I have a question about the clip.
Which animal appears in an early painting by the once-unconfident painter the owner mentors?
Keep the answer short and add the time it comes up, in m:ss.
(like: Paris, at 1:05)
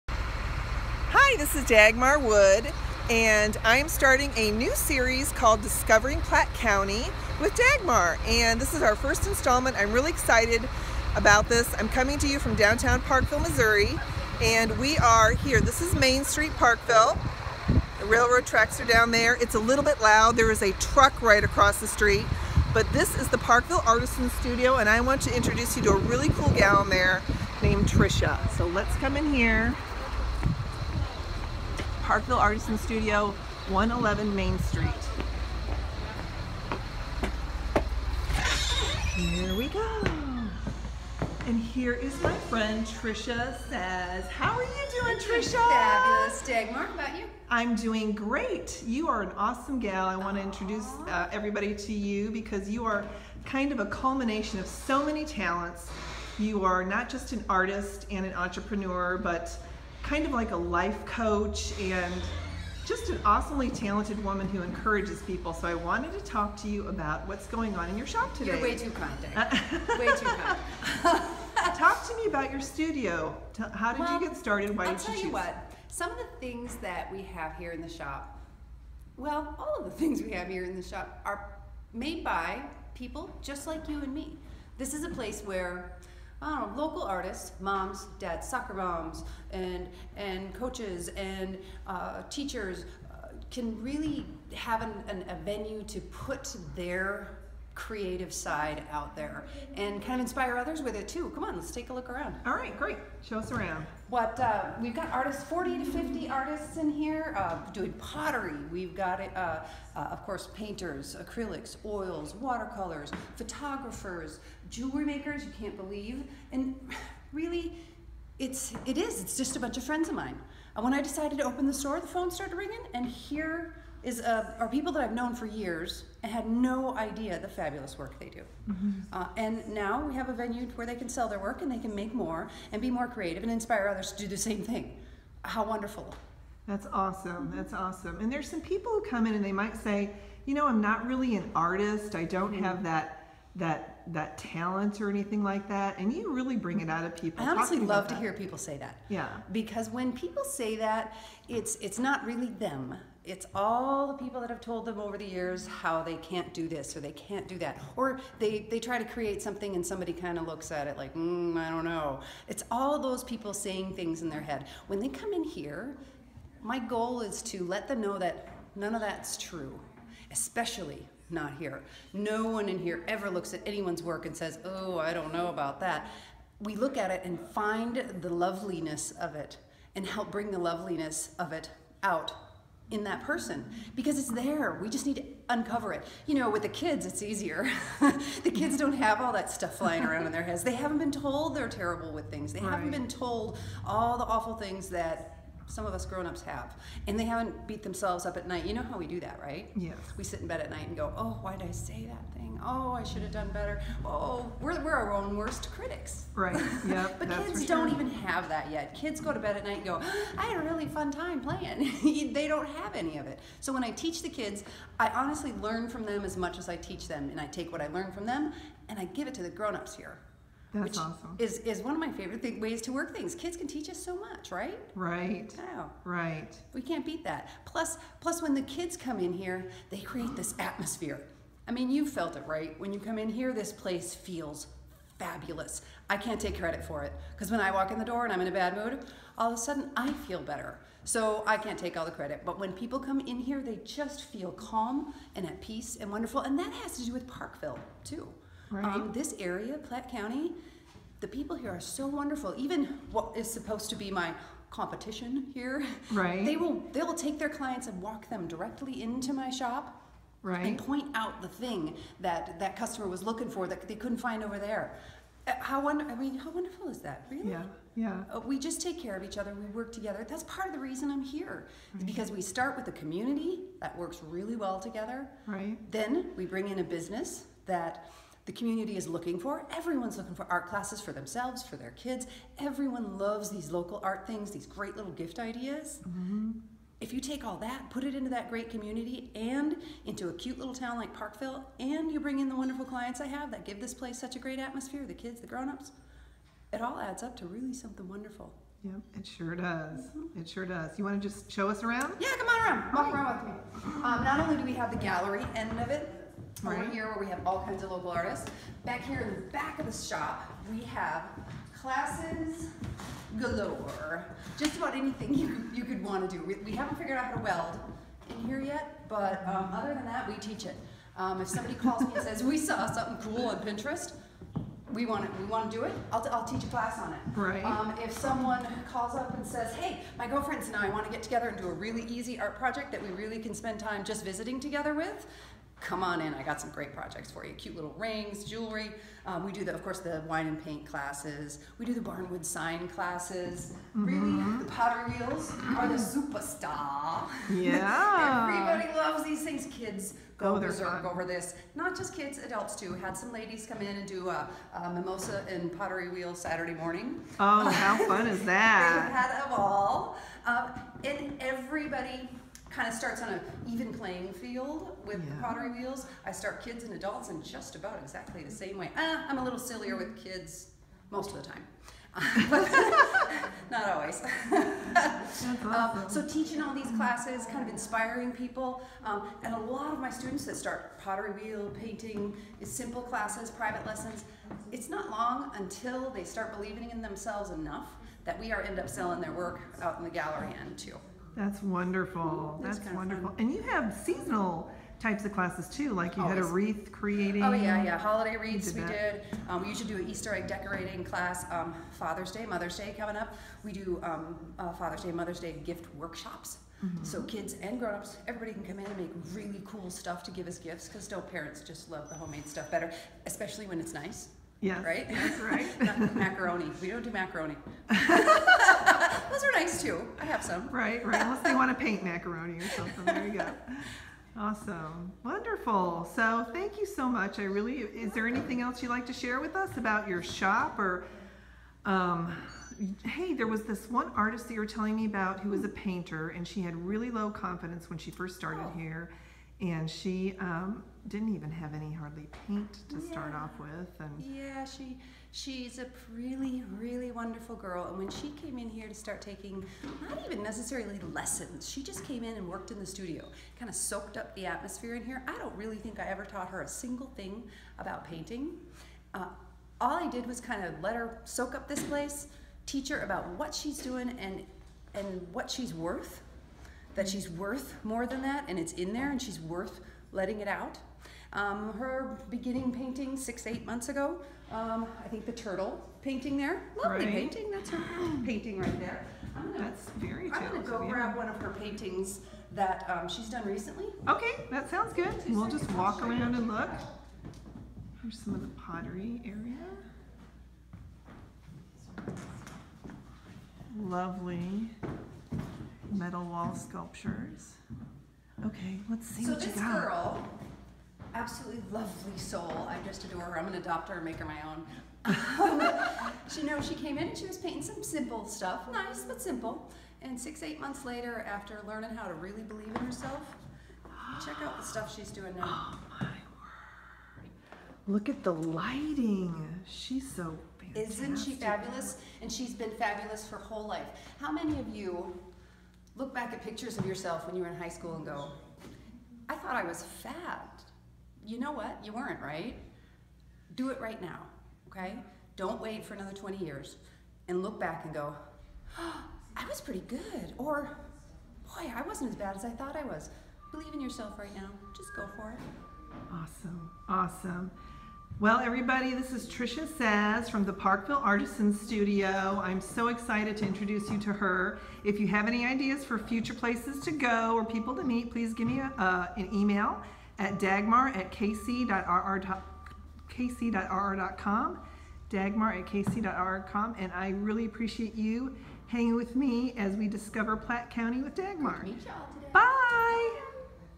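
turtle, at 7:55.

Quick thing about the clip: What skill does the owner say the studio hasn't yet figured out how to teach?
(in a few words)
weld.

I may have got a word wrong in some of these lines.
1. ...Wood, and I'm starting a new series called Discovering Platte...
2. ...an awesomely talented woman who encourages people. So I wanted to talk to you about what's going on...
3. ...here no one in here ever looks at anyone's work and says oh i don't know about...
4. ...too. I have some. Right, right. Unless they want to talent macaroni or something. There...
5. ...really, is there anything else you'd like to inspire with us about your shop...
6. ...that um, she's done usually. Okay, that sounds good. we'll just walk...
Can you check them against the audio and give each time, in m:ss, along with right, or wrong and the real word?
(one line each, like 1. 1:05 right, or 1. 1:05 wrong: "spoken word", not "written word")
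1. 0:02 right
2. 1:03 right
3. 2:51 right
4. 6:59 wrong: "paint", not "talent"
5. 7:07 wrong: "share", not "inspire"
6. 8:02 wrong: "recently", not "usually".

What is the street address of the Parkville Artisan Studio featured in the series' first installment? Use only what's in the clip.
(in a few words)
111 Main Street.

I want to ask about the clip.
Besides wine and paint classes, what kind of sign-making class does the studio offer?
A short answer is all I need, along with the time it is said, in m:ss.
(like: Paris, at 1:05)
barnwood sign, at 5:42.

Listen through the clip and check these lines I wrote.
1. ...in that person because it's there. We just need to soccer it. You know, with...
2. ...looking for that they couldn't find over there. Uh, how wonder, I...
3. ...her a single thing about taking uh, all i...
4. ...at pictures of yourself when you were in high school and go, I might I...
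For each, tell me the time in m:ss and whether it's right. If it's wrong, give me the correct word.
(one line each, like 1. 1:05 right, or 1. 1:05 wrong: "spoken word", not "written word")
1. 3:02 wrong: "uncover", not "soccer"
2. 4:23 right
3. 7:36 wrong: "painting", not "taking"
4. 8:46 wrong: "thought", not "might".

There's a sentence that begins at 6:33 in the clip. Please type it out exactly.
And you have seasonal types of classes too, like you Always.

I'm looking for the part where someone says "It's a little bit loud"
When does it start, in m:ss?
0:19.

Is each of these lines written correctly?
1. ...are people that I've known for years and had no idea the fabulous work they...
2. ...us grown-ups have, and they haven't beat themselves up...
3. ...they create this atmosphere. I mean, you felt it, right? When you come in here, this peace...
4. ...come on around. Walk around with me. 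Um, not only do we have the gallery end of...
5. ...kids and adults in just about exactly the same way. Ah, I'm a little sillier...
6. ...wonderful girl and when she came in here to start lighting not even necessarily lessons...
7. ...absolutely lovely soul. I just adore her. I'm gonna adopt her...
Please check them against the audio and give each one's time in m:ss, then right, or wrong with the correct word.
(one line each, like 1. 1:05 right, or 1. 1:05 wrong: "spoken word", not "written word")
1. 2:04 right
2. 3:15 right
3. 3:49 wrong: "place", not "peace"
4. 5:02 right
5. 6:06 right
6. 7:27 wrong: "taking", not "lighting"
7. 8:21 right.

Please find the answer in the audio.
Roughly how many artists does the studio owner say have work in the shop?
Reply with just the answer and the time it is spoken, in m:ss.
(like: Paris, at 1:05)
40 to 50, at 1:45.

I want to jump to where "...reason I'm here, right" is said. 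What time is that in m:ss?
4:30.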